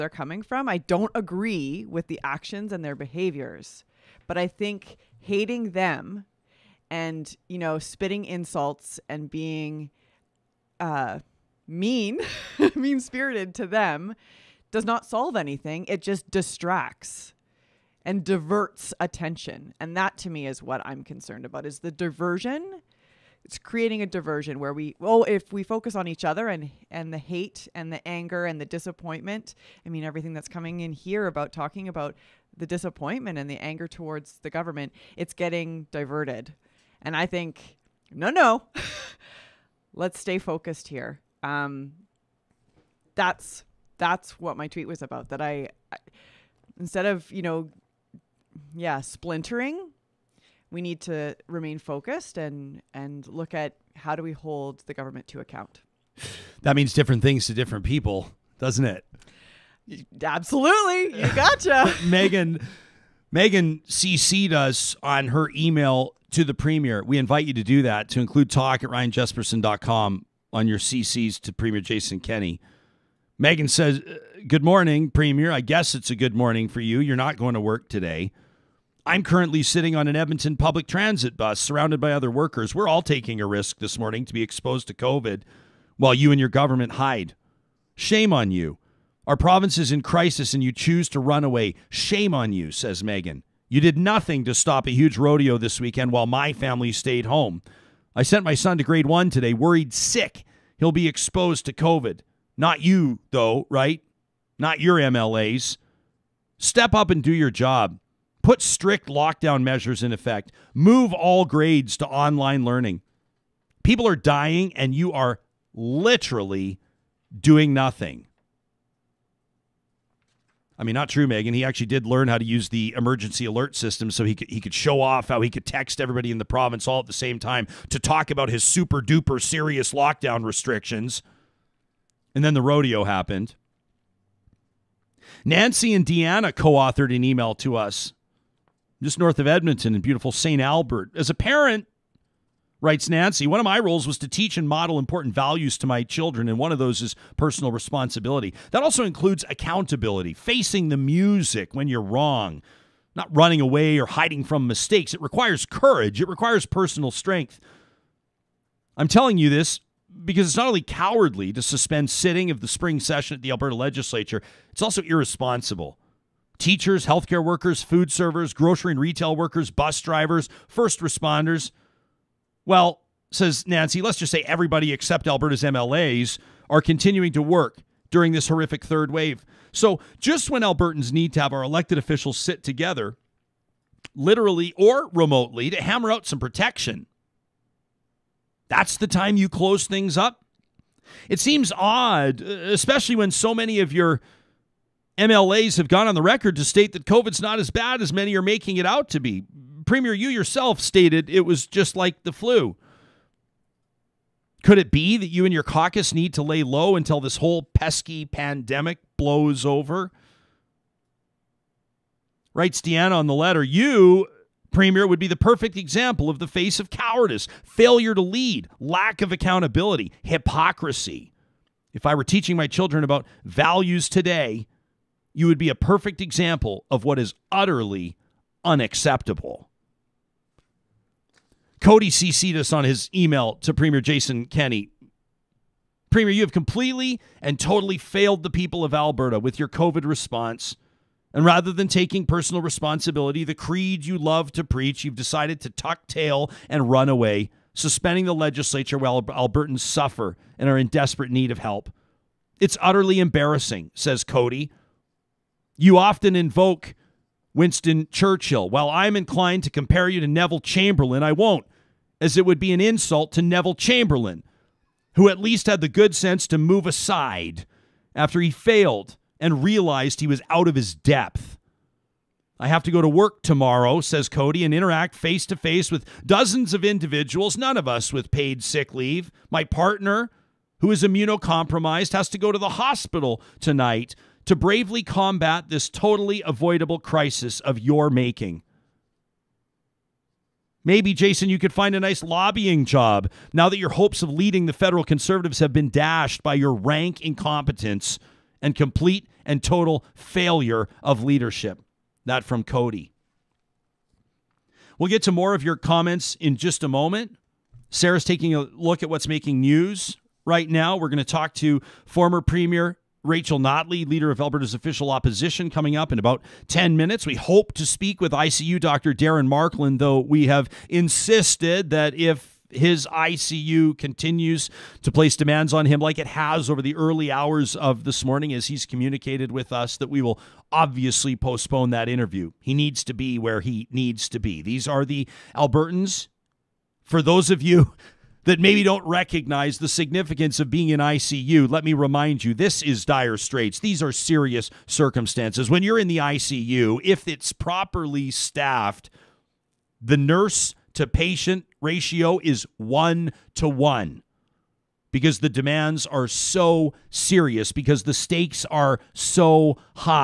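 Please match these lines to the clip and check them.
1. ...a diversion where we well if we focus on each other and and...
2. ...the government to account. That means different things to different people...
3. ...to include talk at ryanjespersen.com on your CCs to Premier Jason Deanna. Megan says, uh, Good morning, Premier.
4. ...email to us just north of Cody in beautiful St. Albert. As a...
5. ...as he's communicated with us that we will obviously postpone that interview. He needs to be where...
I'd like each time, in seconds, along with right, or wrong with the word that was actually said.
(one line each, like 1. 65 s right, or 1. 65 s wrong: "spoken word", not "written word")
1. 24 s right
2. 54 s right
3. 68 s wrong: "Kenney", not "Deanna"
4. 137 s wrong: "Edmonton", not "Cody"
5. 328 s right.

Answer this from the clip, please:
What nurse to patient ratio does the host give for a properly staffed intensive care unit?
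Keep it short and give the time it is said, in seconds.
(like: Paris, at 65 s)
1 to 1, at 352 s.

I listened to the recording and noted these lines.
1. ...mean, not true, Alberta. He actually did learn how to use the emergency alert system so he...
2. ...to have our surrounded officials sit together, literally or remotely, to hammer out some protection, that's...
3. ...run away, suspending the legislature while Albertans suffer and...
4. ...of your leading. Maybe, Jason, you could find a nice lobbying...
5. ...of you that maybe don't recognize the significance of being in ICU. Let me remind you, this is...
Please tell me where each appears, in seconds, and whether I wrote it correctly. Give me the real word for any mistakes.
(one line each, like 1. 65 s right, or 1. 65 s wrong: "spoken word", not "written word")
1. 120 s wrong: "Megan", not "Alberta"
2. 181 s wrong: "elected", not "surrounded"
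3. 246 s right
4. 287 s wrong: "making", not "leading"
5. 337 s right.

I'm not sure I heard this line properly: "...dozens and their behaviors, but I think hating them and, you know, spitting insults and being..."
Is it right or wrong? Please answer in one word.
wrong.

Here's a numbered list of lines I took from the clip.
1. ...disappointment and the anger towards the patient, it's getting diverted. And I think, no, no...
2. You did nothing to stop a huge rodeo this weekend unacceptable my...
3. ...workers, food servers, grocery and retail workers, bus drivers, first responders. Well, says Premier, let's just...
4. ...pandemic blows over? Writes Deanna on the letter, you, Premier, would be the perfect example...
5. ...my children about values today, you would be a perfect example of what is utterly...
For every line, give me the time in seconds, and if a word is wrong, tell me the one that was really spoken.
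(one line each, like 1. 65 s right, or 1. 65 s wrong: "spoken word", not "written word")
1. 32 s wrong: "government", not "patient"
2. 93 s wrong: "while", not "unacceptable"
3. 167 s wrong: "Nancy", not "Premier"
4. 208 s right
5. 222 s right.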